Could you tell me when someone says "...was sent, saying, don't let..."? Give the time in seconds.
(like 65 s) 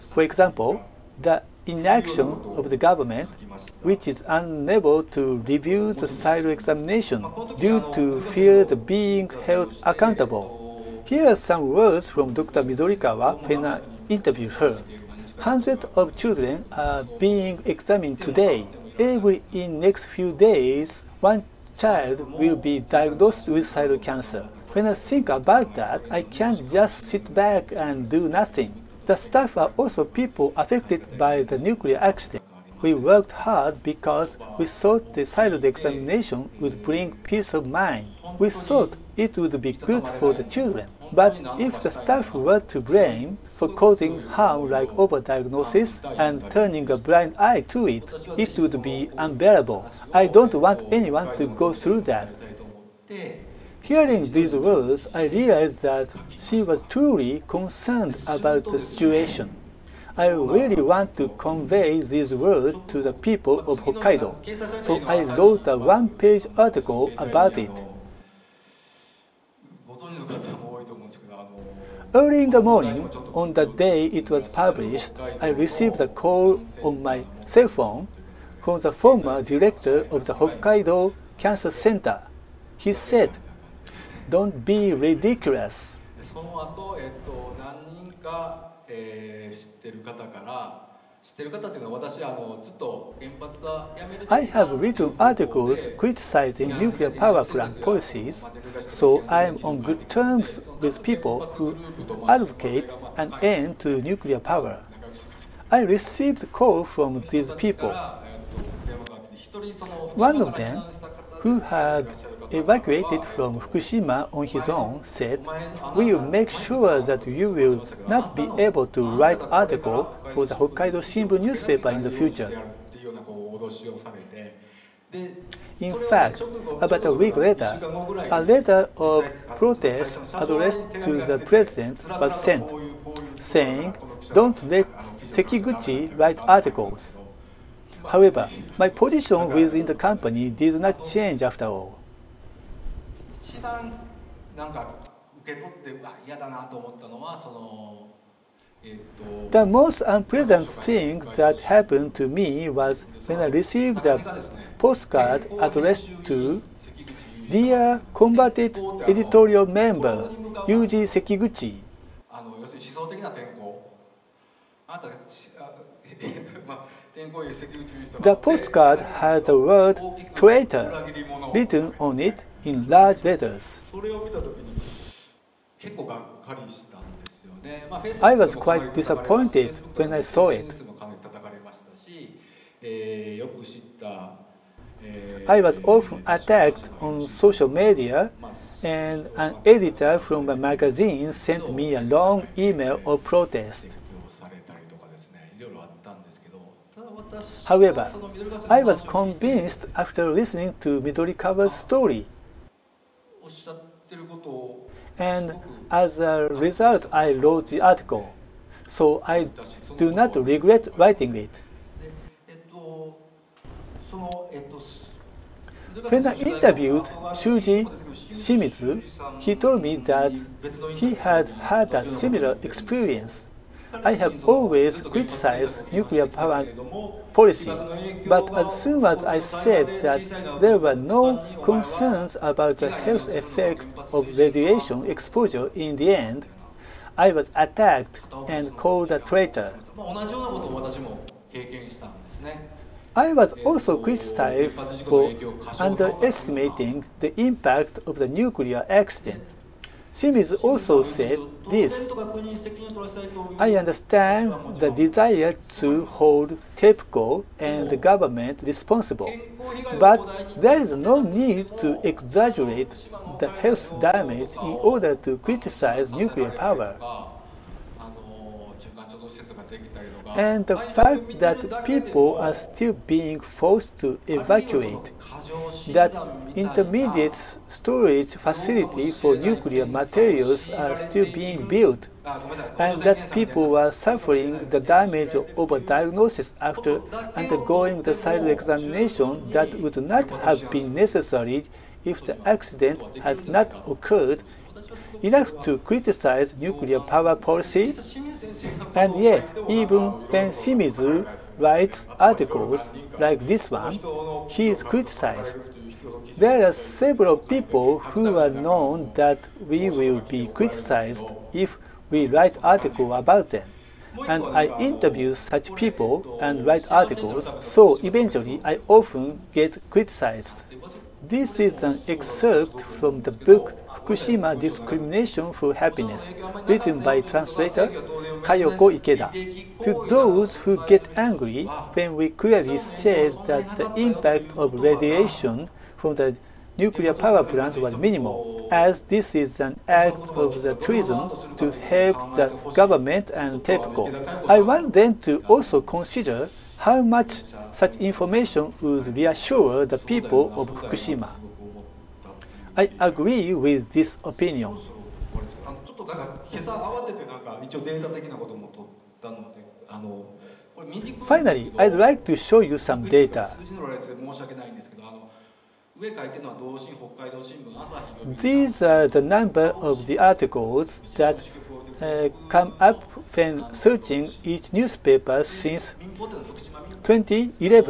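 132 s.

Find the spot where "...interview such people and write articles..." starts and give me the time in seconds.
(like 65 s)
314 s.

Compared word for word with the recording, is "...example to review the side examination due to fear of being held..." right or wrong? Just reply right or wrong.
wrong.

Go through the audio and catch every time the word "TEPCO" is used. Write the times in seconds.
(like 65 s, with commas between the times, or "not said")
256 s, 343 s.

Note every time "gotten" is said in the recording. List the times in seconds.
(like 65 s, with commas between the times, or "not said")
not said.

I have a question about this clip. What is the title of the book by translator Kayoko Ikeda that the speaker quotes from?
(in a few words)
Fukushima Discrimination for Happiness.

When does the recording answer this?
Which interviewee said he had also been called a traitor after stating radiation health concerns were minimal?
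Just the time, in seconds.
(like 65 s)
217 s.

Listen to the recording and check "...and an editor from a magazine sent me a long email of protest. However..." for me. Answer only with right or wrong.
right.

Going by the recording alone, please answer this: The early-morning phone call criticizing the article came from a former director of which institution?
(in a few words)
Hokkaido Cancer Center.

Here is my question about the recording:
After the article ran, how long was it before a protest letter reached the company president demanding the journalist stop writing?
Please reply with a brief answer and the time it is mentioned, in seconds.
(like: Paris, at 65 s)
About a week, at 126 s.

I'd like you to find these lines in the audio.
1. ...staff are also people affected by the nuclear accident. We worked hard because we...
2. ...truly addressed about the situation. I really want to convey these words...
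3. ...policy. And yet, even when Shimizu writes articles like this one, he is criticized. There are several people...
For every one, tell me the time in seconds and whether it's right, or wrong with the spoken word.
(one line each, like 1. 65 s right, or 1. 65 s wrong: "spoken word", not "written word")
1. 29 s right
2. 56 s wrong: "concerned", not "addressed"
3. 297 s right.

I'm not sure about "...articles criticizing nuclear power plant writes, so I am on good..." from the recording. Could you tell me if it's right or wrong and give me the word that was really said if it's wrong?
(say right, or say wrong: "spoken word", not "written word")
wrong: "policies", not "writes".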